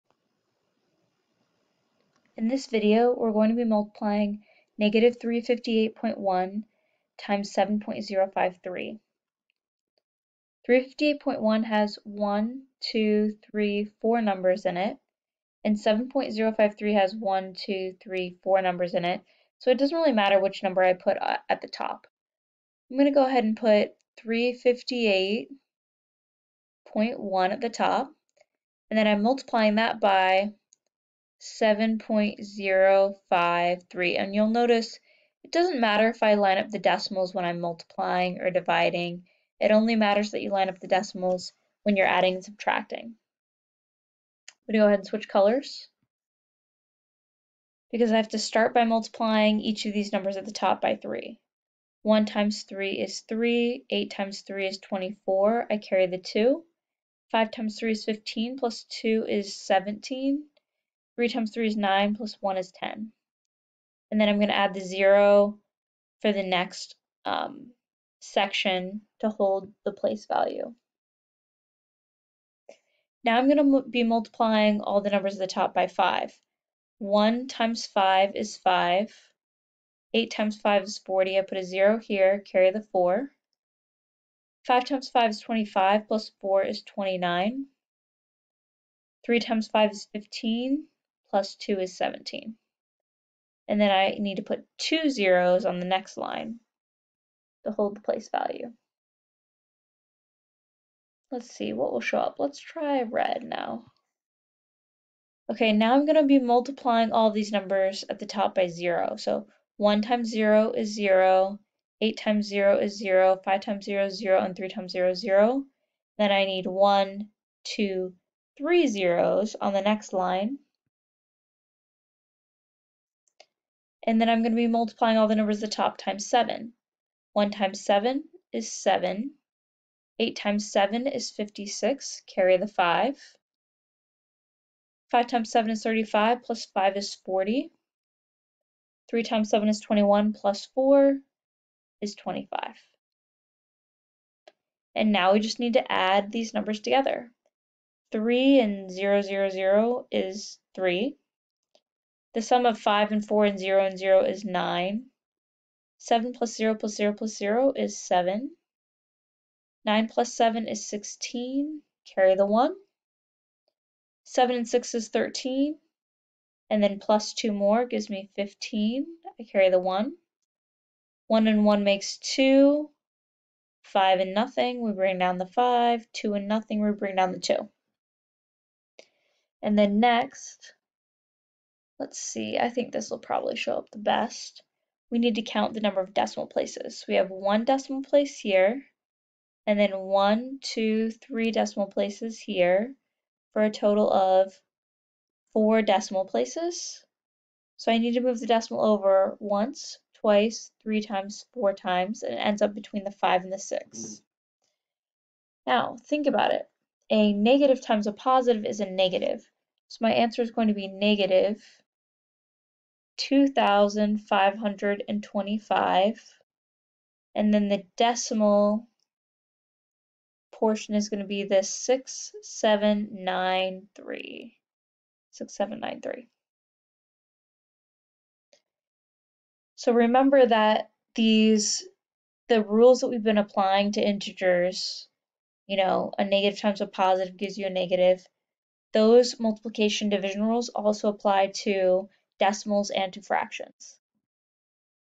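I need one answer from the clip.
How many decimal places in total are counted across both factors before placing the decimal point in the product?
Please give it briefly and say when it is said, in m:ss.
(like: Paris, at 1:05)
4, at 3:15.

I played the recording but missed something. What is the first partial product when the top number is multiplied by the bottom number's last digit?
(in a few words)
1074.3 (digits 10743).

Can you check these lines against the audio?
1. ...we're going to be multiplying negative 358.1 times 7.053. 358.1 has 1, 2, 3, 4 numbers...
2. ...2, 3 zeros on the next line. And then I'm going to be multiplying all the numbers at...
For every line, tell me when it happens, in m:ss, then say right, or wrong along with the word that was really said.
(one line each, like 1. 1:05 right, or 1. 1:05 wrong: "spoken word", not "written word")
1. 0:03 right
2. 1:57 right.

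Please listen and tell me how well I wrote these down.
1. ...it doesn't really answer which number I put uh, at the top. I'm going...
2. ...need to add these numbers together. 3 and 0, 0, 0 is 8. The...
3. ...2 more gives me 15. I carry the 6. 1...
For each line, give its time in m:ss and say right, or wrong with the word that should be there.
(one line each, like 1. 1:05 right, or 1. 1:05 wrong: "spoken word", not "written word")
1. 0:19 wrong: "matter", not "answer"
2. 2:25 wrong: "3", not "8"
3. 2:47 wrong: "1", not "6".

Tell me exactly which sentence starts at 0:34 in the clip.
And you'll notice it doesn't matter if I line up the decimals when I'm multiplying or dividing.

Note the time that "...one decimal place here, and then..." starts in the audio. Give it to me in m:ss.
3:07.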